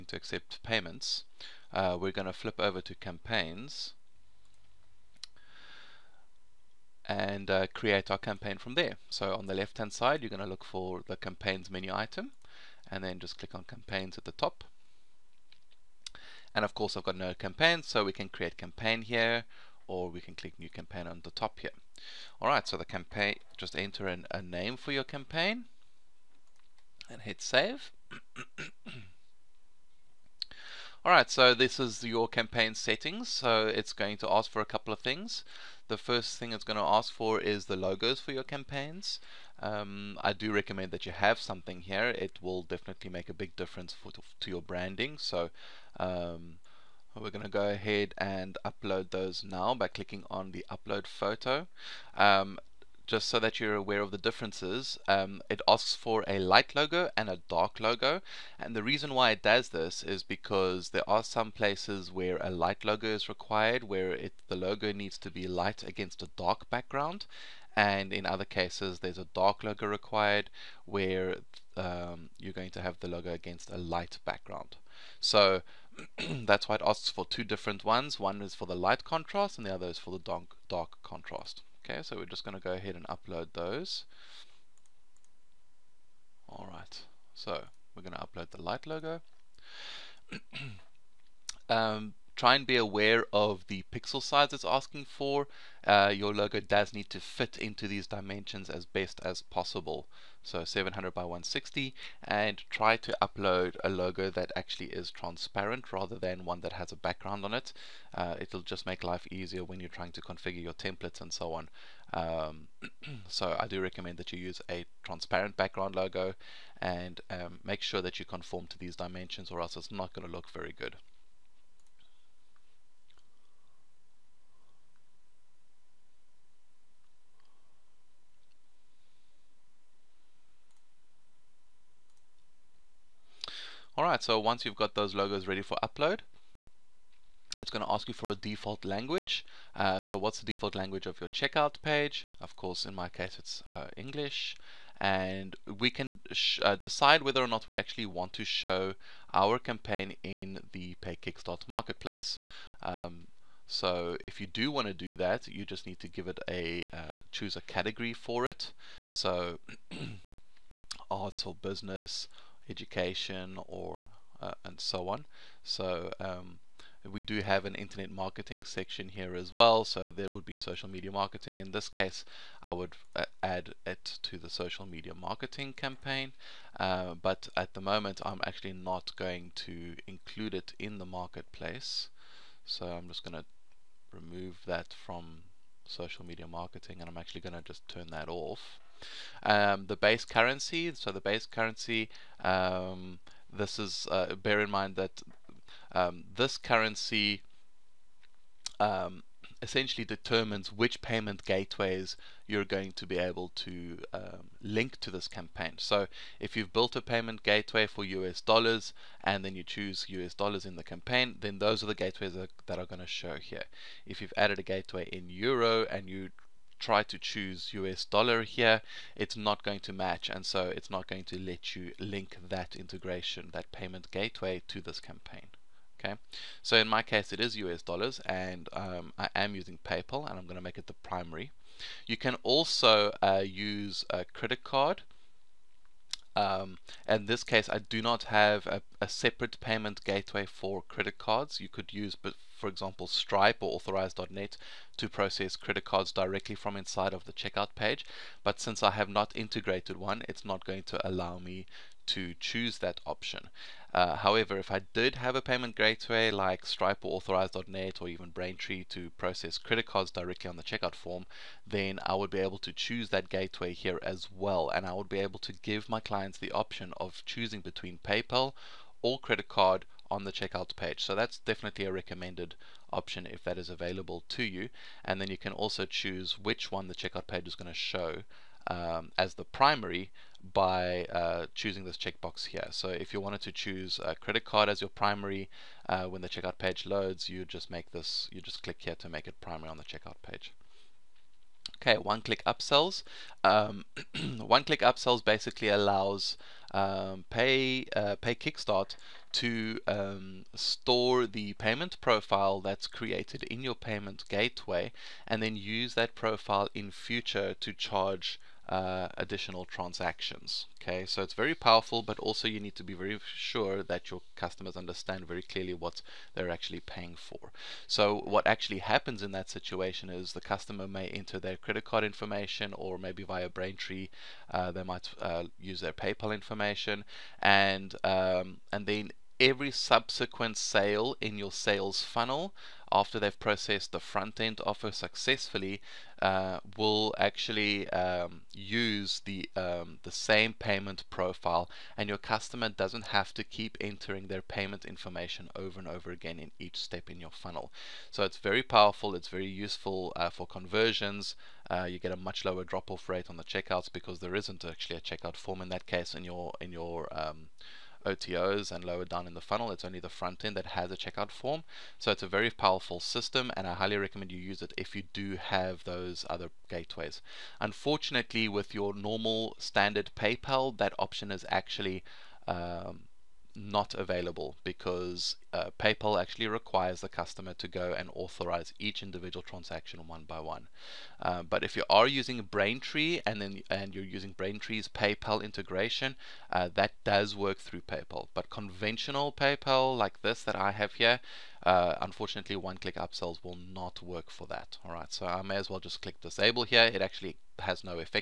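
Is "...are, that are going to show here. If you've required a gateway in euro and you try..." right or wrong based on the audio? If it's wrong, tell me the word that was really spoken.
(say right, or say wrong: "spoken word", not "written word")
wrong: "added", not "required".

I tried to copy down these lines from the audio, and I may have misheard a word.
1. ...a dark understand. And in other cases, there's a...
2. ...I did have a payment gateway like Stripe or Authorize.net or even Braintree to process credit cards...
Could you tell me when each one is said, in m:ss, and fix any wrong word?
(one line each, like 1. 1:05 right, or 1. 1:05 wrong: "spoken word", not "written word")
1. 1:06 wrong: "background", not "understand"
2. 4:14 right.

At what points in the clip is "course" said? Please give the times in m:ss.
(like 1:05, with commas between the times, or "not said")
0:16, 2:22.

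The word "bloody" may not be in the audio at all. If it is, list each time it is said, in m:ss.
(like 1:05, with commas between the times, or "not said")
not said.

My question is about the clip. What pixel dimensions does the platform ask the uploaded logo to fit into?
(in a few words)
700 by 160.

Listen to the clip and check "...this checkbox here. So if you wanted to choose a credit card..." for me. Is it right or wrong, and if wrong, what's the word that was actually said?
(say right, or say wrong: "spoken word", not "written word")
right.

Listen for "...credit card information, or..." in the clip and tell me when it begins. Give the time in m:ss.
5:21.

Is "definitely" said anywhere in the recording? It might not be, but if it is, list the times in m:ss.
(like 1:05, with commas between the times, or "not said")
0:42, 4:31.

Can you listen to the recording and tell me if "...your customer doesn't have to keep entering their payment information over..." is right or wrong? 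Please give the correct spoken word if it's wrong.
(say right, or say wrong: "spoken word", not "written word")
right.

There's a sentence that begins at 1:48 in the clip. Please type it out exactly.
Uh, it'll just make life easier when you're trying to configure your templates and so on.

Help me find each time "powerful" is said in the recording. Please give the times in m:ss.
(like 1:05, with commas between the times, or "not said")
5:11, 5:48, 6:02.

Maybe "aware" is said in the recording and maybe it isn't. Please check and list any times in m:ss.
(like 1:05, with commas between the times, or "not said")
0:53, 1:32.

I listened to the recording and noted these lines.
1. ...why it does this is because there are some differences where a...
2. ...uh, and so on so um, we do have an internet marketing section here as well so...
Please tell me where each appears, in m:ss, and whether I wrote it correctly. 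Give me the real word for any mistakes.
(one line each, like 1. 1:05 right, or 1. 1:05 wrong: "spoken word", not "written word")
1. 0:59 wrong: "places", not "differences"
2. 2:44 right.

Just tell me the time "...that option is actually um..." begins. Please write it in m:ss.
6:10.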